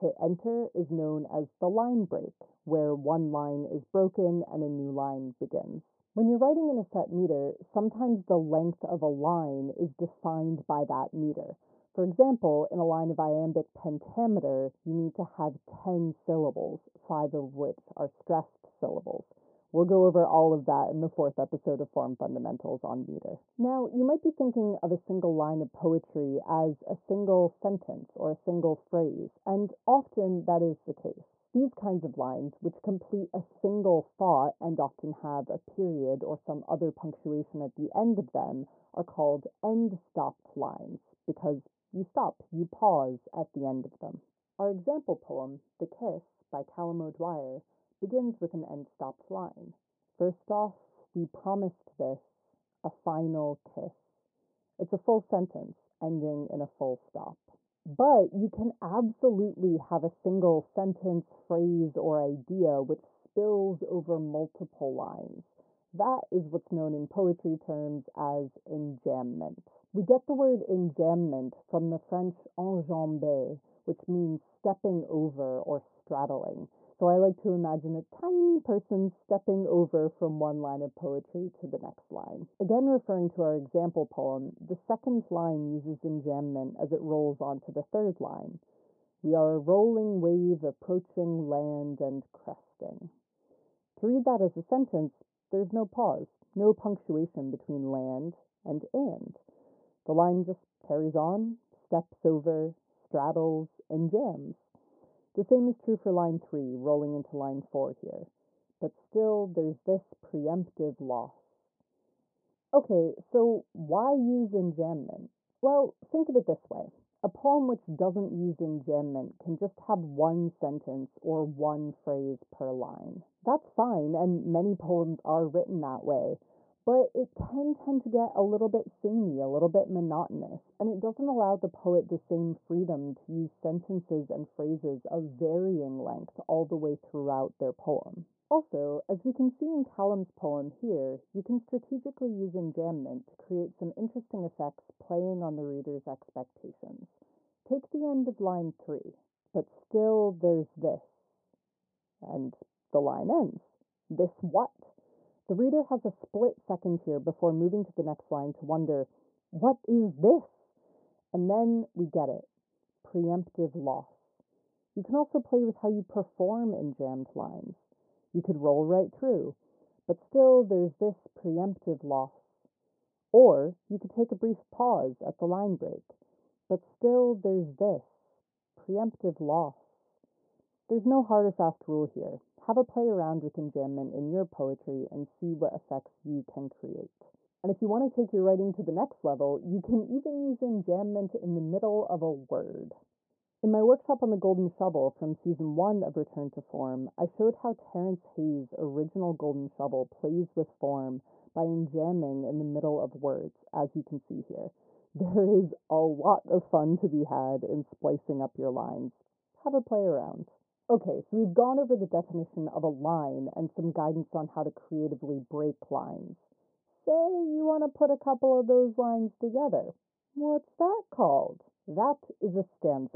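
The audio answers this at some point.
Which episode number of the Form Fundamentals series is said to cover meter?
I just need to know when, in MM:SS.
00:21.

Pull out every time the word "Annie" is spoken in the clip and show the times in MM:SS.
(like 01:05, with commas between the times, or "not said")
not said.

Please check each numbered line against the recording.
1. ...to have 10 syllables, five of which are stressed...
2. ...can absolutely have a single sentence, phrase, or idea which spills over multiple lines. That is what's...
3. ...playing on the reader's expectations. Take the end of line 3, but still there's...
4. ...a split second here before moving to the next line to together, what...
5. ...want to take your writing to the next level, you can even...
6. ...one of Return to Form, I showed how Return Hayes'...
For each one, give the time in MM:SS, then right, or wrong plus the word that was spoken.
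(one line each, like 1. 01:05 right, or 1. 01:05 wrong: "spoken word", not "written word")
1. 00:15 right
2. 00:58 right
3. 02:24 right
4. 02:36 wrong: "wonder", not "together"
5. 03:07 right
6. 03:15 wrong: "Terrance", not "Return".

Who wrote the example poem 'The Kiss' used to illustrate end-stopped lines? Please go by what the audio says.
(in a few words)
Callum O'Dwyer.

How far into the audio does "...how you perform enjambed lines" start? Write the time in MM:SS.
02:45.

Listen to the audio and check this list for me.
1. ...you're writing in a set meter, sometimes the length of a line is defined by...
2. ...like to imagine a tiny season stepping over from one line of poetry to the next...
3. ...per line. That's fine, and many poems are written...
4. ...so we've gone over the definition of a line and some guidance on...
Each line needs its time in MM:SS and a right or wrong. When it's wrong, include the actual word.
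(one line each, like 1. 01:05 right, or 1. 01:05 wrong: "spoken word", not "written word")
1. 00:06 right
2. 01:17 wrong: "person", not "season"
3. 02:02 right
4. 03:31 right.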